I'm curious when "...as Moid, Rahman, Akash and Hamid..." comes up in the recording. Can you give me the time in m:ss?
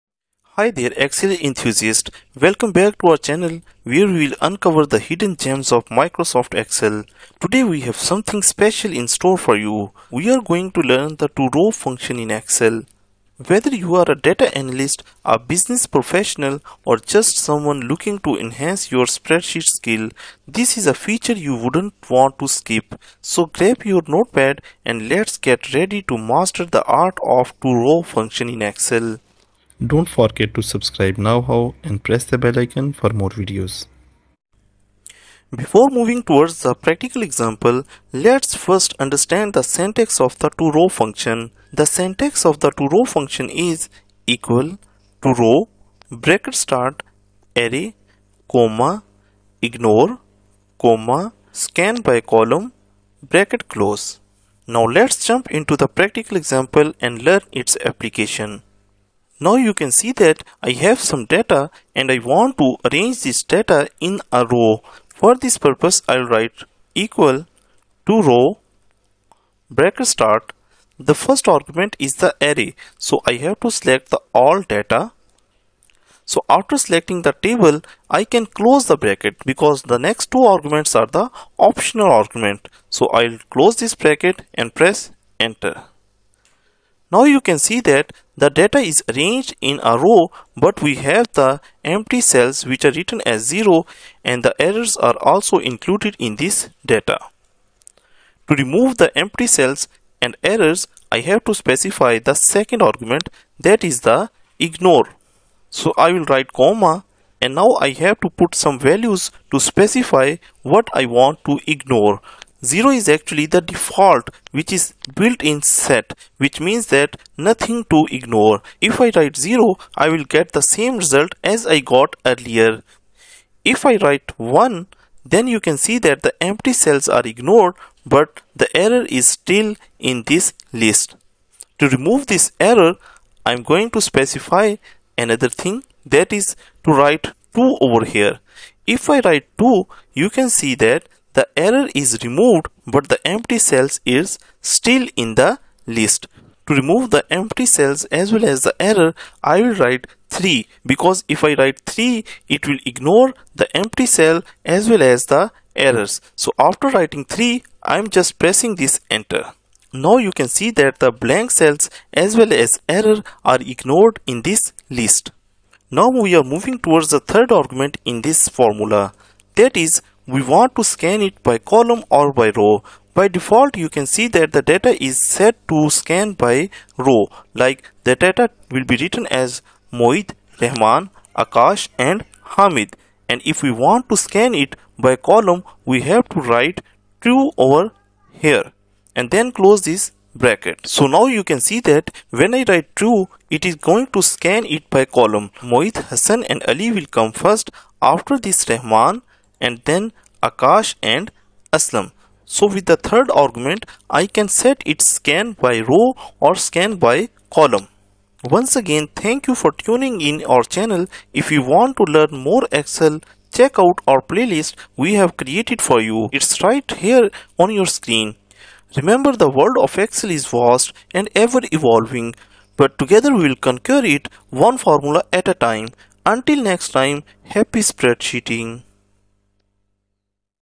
2:59.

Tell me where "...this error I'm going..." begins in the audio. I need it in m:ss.
2:12.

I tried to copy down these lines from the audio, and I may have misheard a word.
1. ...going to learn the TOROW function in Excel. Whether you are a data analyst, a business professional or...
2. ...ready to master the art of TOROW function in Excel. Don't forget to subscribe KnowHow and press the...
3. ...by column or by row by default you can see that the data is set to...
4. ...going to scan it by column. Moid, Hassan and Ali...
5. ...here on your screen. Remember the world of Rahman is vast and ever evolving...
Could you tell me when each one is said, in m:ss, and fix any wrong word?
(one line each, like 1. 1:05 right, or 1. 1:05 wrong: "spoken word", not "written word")
1. 0:10 right
2. 0:25 right
3. 2:51 right
4. 3:13 right
5. 3:36 wrong: "Excel", not "Rahman".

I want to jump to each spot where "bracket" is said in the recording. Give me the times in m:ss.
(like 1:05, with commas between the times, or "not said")
0:46, 0:53, 1:09, 1:18, 1:23, 3:10.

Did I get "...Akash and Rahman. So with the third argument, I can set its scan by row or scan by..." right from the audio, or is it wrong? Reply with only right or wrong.
wrong.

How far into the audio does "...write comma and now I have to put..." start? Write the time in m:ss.
1:46.